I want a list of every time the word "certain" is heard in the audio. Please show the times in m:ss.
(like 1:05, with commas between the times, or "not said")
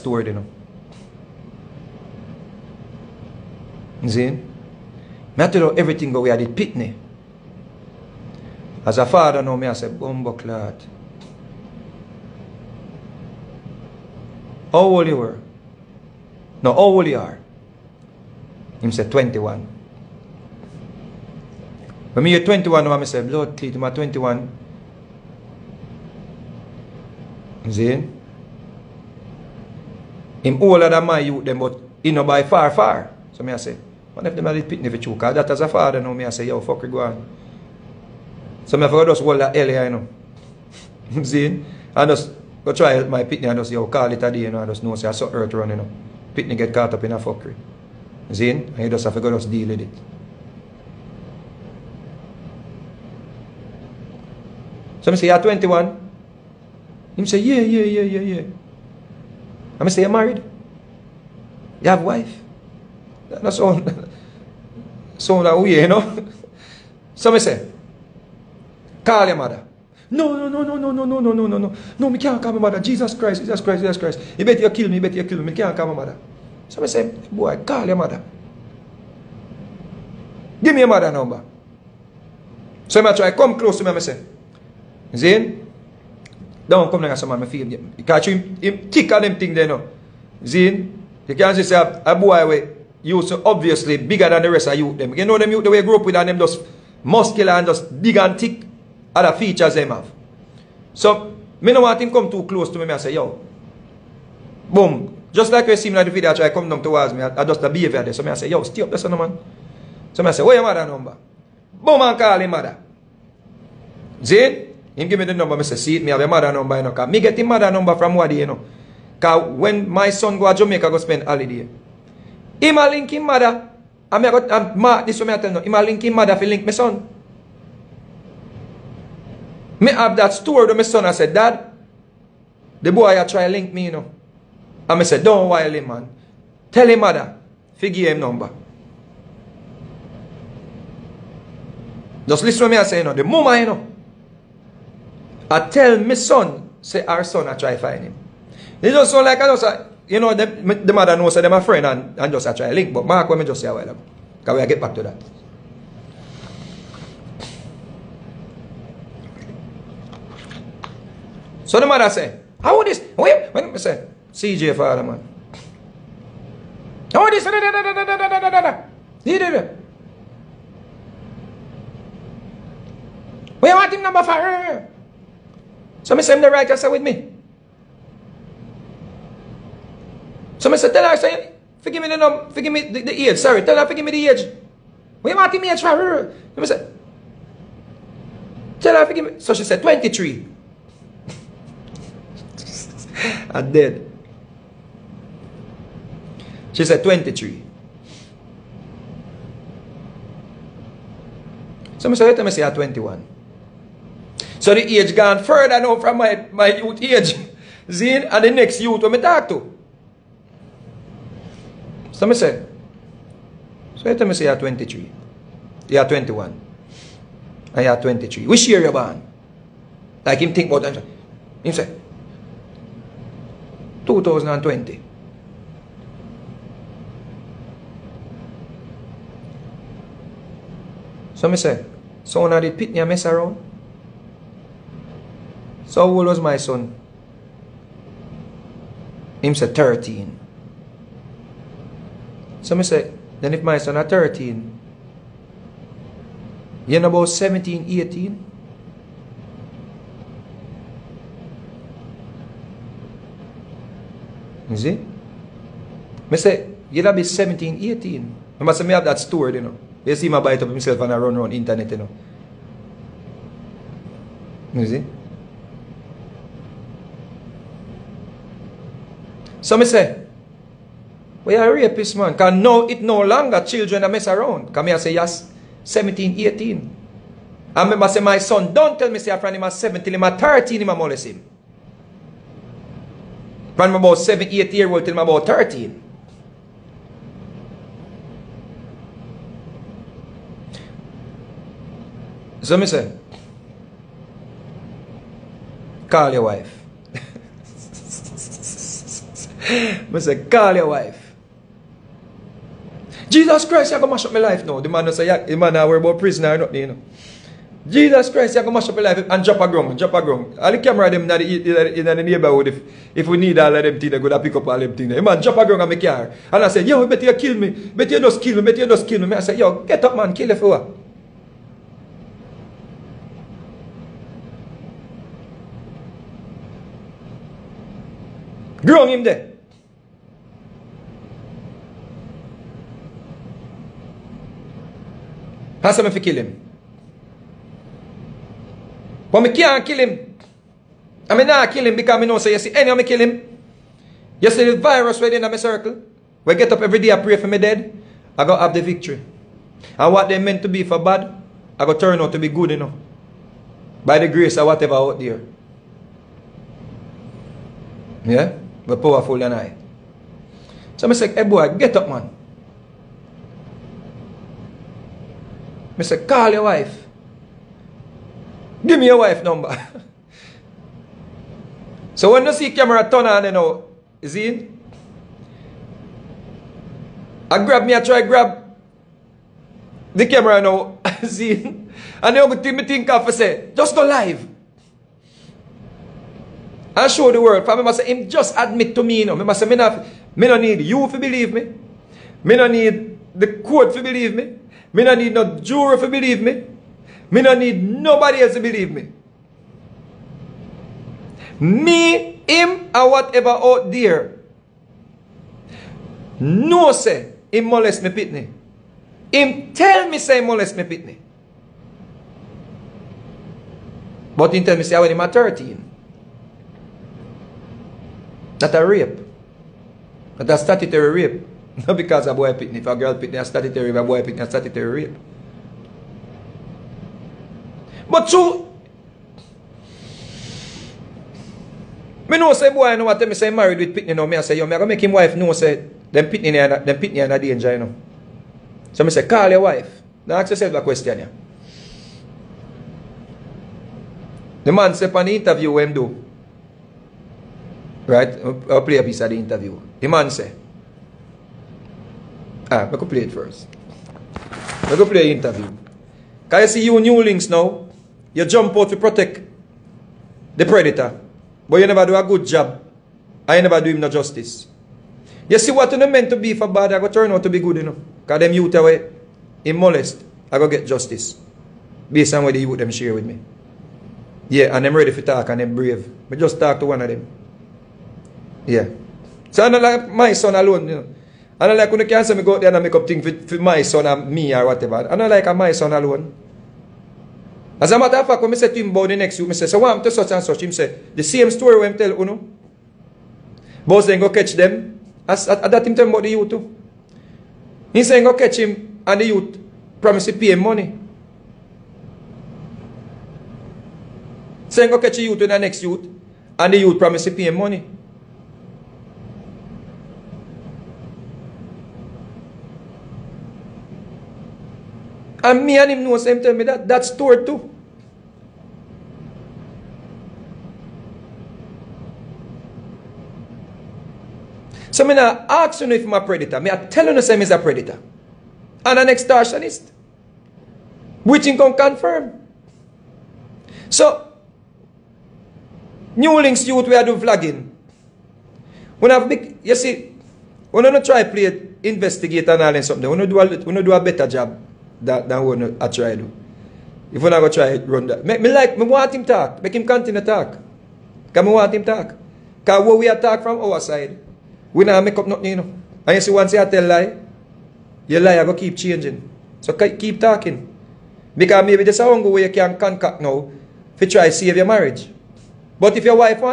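not said.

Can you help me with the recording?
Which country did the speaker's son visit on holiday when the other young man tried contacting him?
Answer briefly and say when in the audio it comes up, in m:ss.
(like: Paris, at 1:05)
Jamaica, at 2:00.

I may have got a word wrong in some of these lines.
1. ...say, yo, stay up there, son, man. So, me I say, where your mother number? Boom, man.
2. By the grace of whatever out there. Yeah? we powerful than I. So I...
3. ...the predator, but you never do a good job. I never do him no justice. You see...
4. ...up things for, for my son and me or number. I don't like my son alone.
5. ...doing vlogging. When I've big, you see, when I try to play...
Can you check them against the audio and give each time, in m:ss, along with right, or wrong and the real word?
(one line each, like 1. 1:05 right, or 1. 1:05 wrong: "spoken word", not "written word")
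1. 1:48 right
2. 5:54 right
3. 7:40 right
4. 8:02 wrong: "whatever", not "number"
5. 8:57 right.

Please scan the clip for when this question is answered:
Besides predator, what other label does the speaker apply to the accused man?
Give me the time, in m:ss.
8:49.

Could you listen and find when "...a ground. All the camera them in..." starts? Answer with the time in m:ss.
5:10.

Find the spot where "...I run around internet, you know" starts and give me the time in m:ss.
4:21.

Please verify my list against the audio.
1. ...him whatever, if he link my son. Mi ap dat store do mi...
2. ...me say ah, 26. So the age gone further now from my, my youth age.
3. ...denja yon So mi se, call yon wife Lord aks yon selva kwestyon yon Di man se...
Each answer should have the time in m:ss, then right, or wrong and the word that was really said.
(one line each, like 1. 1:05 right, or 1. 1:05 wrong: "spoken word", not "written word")
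1. 2:06 wrong: "mother", not "whatever"
2. 3:22 wrong: "21", not "26"
3. 7:17 wrong: "Dan", not "Lord".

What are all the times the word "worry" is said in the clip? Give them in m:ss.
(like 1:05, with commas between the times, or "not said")
5:05.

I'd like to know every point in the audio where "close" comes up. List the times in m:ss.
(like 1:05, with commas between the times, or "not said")
1:23, 1:42.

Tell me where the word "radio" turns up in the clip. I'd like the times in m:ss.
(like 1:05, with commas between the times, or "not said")
not said.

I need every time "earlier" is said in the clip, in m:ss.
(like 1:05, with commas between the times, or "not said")
0:39.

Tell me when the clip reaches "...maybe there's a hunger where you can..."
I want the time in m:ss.
9:21.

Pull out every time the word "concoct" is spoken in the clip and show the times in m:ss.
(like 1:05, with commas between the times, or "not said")
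9:22.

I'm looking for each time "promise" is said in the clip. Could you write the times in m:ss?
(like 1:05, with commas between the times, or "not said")
8:20, 8:27.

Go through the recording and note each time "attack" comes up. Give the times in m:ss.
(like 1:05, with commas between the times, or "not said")
9:13.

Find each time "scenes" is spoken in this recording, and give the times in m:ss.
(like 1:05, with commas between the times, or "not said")
not said.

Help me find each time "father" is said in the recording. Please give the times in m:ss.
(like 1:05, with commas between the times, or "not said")
0:35.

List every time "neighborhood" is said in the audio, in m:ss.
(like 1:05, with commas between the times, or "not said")
5:12.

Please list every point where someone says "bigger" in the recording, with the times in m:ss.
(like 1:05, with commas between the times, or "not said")
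1:33.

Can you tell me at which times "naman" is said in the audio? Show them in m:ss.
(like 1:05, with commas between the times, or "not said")
2:41.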